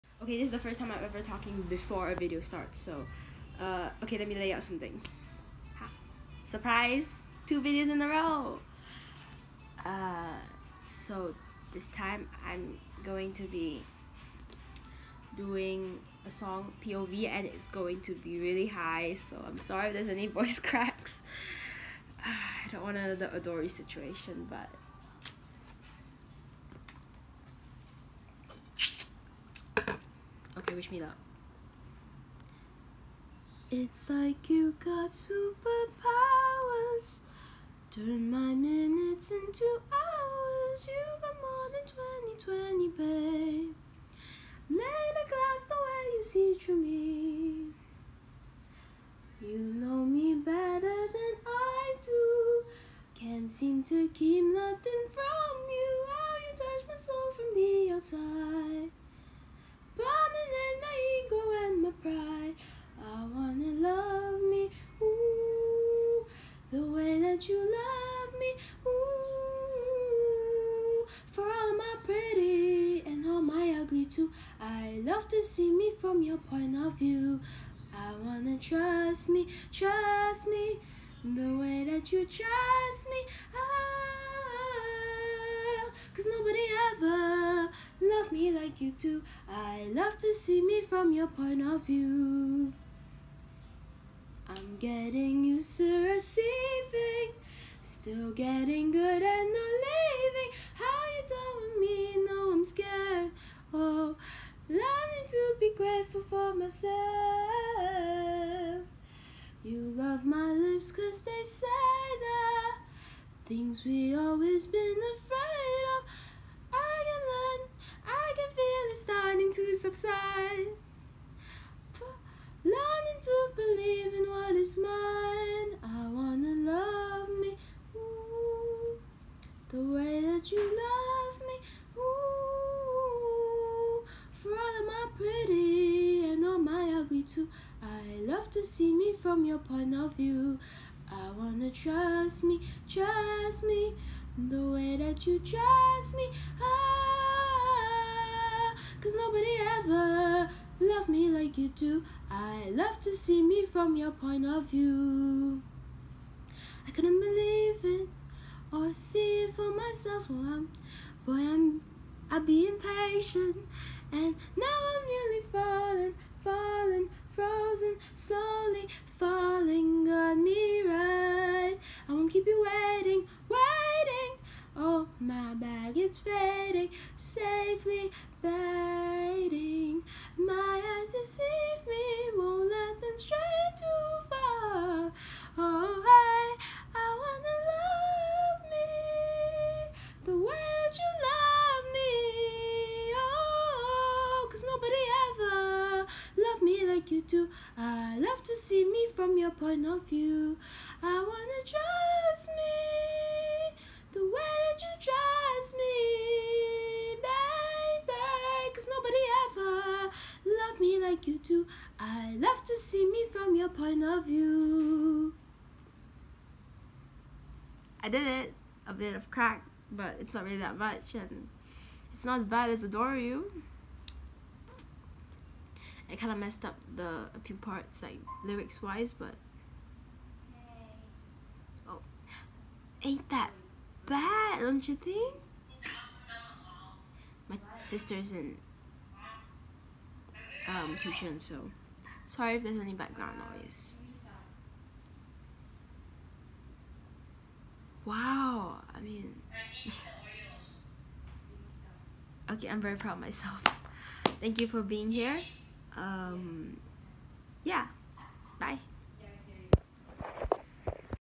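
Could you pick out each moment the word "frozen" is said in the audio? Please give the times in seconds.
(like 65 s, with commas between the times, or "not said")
167 s.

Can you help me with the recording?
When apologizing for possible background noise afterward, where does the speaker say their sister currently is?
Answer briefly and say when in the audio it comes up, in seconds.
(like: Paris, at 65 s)
tuition, at 240 s.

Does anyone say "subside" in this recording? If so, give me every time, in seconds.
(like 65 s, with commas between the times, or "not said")
119 s.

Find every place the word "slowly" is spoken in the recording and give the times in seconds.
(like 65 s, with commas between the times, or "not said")
168 s.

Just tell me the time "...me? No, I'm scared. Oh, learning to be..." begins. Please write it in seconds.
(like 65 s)
101 s.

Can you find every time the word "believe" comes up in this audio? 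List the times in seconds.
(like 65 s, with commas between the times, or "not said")
123 s, 157 s.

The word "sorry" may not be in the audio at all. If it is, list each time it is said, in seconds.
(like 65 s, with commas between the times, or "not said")
19 s, 242 s.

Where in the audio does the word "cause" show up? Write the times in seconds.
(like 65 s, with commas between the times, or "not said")
86 s, 110 s, 149 s, 194 s.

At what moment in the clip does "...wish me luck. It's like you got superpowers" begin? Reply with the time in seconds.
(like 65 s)
30 s.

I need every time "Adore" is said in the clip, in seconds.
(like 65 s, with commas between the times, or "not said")
23 s, 222 s.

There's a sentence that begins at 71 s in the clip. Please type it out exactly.
For all my pretty and all my ugly too, I love to see me from your point of view.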